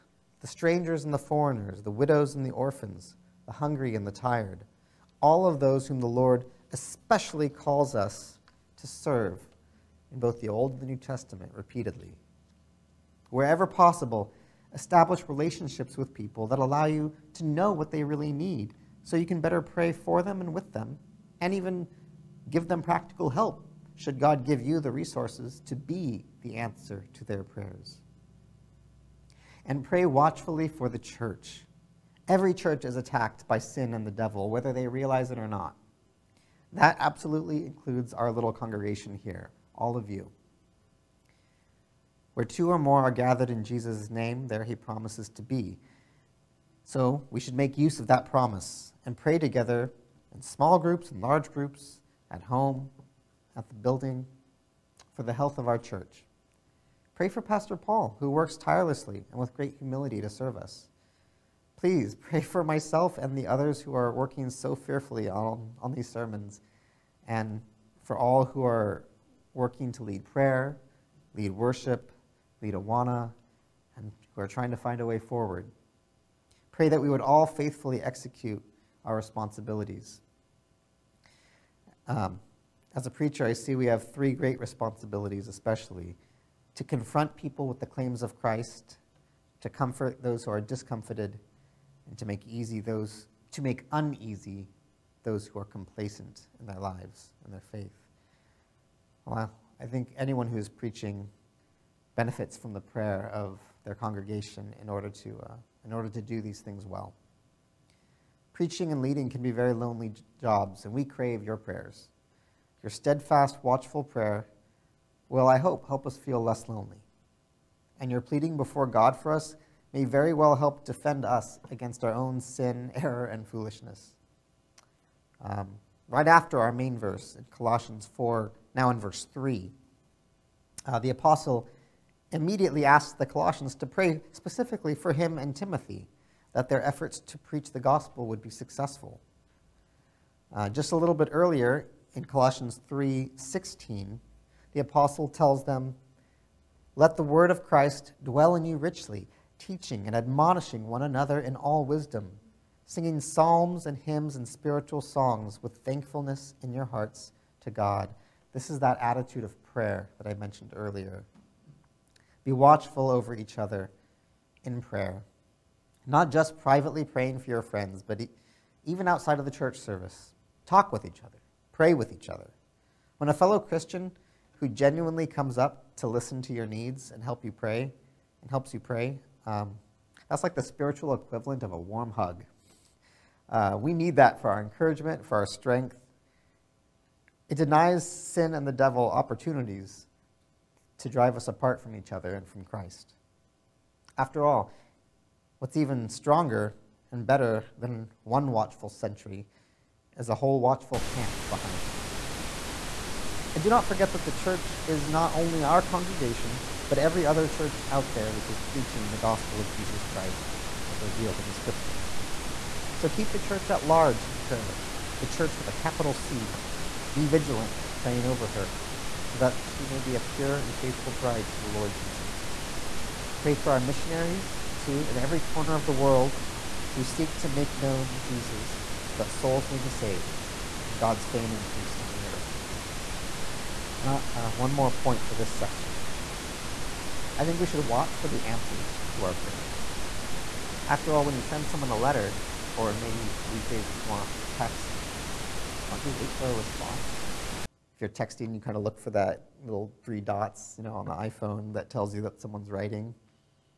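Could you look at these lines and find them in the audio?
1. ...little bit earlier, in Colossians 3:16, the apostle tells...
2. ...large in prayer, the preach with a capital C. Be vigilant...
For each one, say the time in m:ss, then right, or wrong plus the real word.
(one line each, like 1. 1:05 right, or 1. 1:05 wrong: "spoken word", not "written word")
1. 2:20 right
2. 3:33 wrong: "church", not "preach".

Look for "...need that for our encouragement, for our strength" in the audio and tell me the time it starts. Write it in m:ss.
3:03.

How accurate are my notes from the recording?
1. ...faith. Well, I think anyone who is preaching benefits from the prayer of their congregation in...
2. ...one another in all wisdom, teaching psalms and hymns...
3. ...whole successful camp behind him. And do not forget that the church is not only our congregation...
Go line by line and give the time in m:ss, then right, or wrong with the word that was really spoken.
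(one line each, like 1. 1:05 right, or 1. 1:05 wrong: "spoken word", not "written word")
1. 1:37 right
2. 2:30 wrong: "singing", not "teaching"
3. 3:20 wrong: "watchful", not "successful".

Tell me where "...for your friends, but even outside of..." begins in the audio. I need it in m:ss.
2:47.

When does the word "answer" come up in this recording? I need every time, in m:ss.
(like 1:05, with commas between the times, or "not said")
0:26, 3:58.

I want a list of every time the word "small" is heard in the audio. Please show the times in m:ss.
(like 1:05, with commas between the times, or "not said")
0:50.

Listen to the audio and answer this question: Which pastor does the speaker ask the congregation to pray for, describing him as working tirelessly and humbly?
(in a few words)
Pastor Paul.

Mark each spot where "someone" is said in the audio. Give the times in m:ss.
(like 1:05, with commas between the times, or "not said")
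4:01, 4:12.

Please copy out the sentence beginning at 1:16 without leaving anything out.
Pray that we would all faithfully execute our responsibilities.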